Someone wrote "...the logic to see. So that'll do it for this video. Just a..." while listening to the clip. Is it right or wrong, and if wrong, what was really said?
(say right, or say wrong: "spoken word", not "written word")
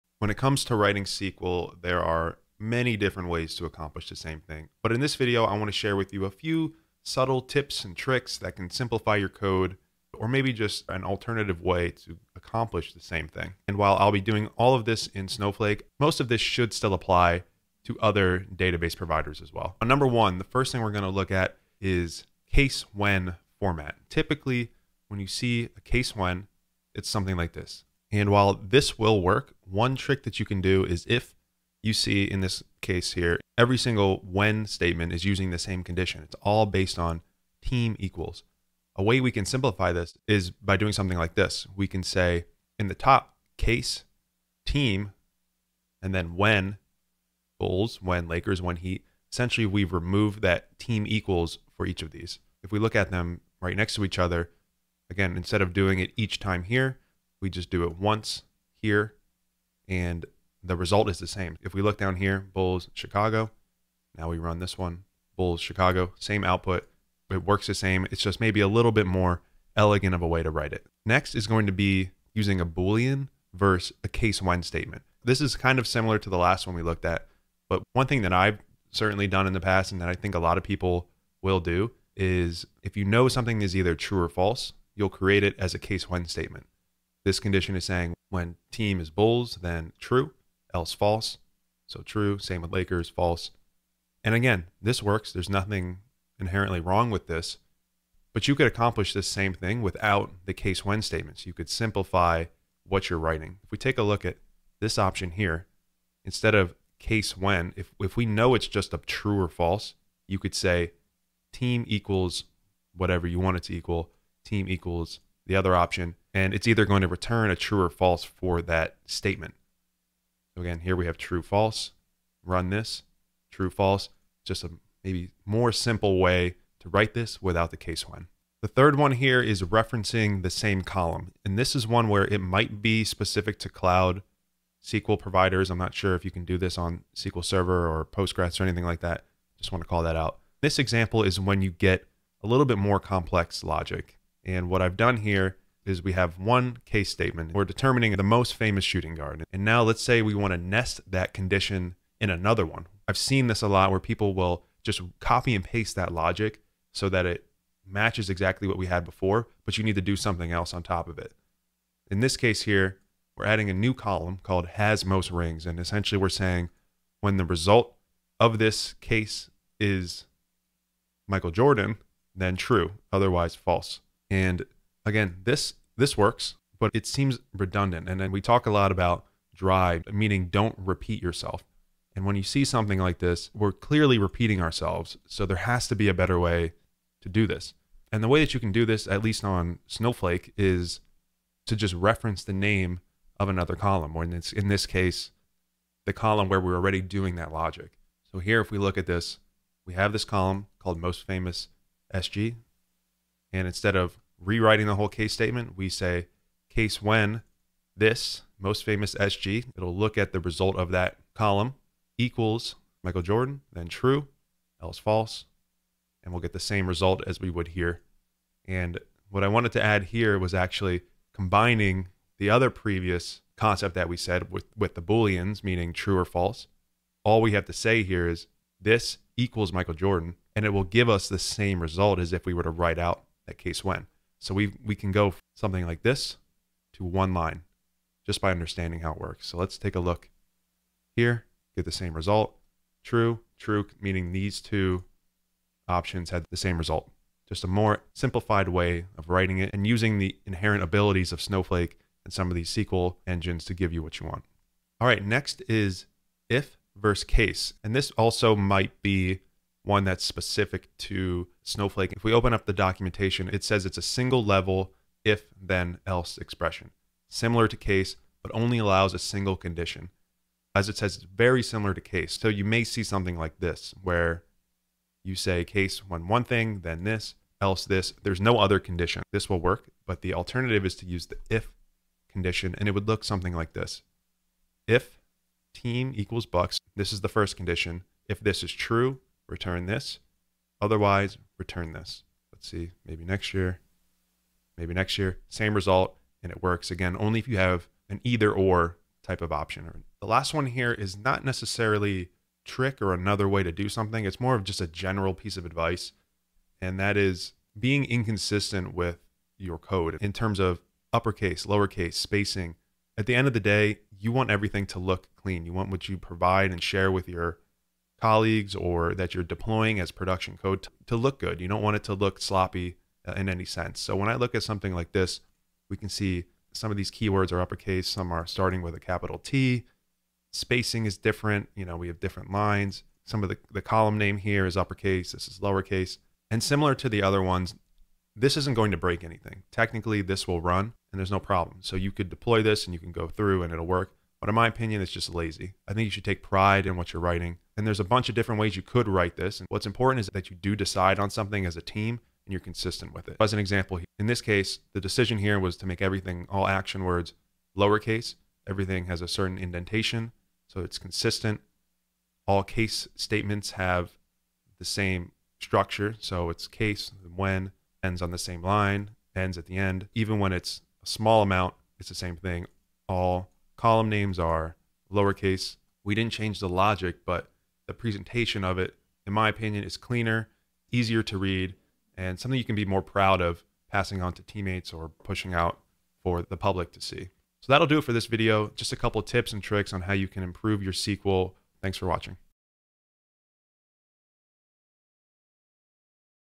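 wrong: "public", not "logic".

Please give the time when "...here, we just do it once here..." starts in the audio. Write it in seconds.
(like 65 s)
56 s.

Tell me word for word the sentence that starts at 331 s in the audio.
You know, we have different lines.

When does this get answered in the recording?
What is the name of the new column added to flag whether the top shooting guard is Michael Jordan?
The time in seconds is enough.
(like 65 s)
164 s.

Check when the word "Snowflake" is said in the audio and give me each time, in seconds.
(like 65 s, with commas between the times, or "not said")
15 s, 189 s, 251 s, 261 s.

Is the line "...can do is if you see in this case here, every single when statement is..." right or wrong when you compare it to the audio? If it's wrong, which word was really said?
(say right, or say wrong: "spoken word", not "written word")
right.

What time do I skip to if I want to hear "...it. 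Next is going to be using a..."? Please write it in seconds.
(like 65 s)
70 s.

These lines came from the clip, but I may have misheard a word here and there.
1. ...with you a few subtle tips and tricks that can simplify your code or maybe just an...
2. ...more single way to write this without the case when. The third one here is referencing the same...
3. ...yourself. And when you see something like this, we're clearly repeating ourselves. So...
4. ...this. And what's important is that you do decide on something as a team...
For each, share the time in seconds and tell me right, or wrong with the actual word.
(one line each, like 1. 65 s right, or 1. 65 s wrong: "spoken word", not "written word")
1. 5 s right
2. 125 s wrong: "simple", not "single"
3. 181 s right
4. 349 s right.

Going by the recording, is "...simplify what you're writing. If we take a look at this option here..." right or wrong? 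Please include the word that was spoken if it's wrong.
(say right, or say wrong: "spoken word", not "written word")
right.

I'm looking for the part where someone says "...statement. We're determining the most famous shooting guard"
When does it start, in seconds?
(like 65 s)
147 s.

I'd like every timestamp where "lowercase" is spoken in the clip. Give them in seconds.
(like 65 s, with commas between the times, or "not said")
311 s, 335 s, 357 s, 375 s.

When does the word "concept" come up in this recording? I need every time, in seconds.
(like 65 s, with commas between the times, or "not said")
223 s.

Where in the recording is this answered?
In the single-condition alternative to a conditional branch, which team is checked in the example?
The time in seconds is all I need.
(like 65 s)
286 s.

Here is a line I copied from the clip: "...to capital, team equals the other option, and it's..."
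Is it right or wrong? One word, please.
wrong.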